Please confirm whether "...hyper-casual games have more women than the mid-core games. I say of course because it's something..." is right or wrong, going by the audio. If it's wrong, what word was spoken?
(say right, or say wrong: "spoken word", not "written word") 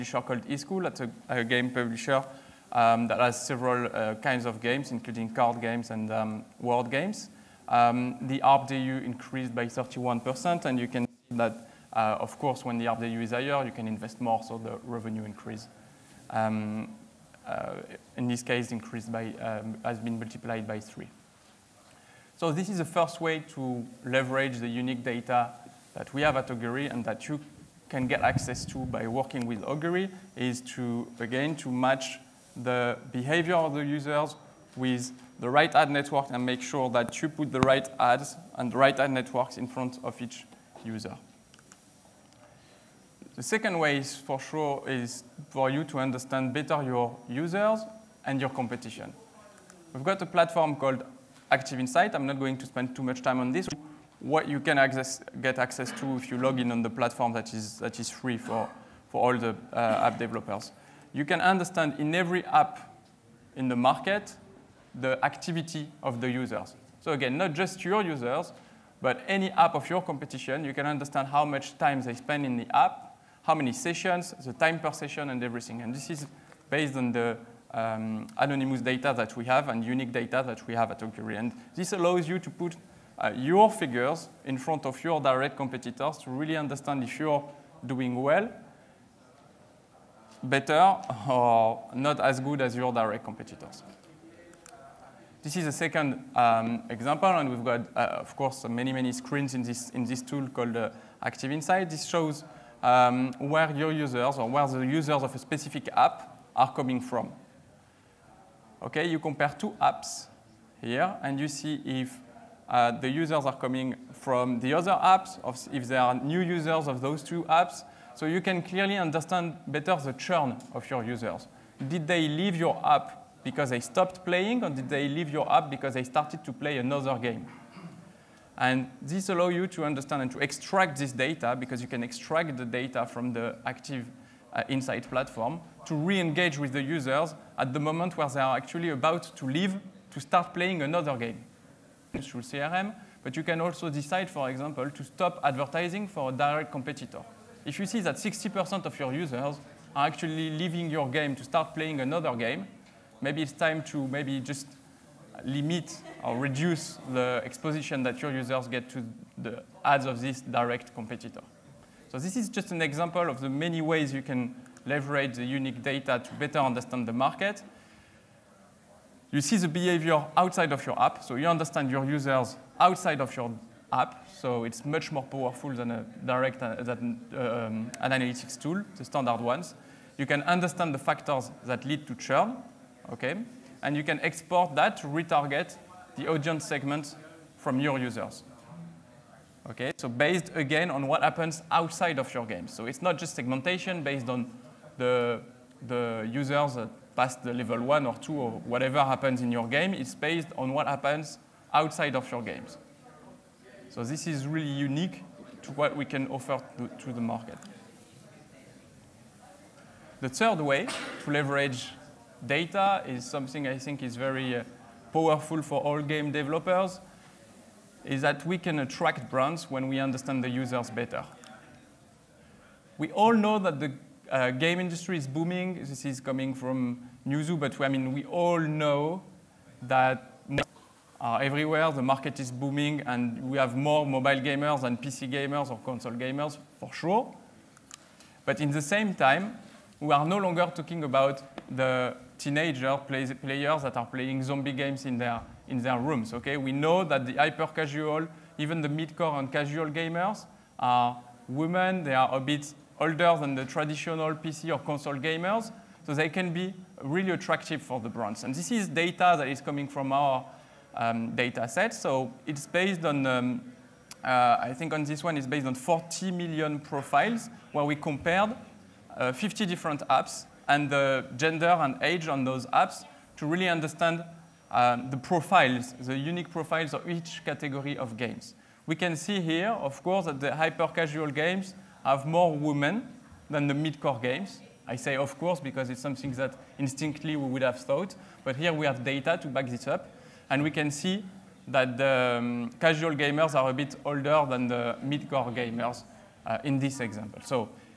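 right.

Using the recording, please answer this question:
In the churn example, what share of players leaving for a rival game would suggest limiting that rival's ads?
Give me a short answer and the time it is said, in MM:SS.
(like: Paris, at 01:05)
60%, at 02:28.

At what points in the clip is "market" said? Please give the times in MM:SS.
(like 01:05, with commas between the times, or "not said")
01:03, 02:47, 03:27, 03:52.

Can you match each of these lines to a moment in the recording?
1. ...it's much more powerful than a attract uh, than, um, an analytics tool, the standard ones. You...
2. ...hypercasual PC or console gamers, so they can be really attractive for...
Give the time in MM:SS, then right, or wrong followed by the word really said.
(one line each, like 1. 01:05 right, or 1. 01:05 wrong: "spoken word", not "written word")
1. 02:54 wrong: "direct", not "attract"
2. 04:13 wrong: "traditional", not "hypercasual".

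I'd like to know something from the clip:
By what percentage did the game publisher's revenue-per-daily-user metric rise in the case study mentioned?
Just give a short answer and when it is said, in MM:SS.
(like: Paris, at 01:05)
31%, at 00:09.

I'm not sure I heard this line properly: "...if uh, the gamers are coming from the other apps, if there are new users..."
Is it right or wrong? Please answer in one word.
wrong.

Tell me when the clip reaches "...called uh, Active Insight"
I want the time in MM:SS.
01:40.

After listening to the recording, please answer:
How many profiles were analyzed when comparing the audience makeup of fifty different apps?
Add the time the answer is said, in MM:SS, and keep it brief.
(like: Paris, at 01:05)
40 million, at 04:25.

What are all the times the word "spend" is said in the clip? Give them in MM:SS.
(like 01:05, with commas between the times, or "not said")
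00:52, 01:12.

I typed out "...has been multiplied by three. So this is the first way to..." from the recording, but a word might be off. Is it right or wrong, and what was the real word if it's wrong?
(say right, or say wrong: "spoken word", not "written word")
right.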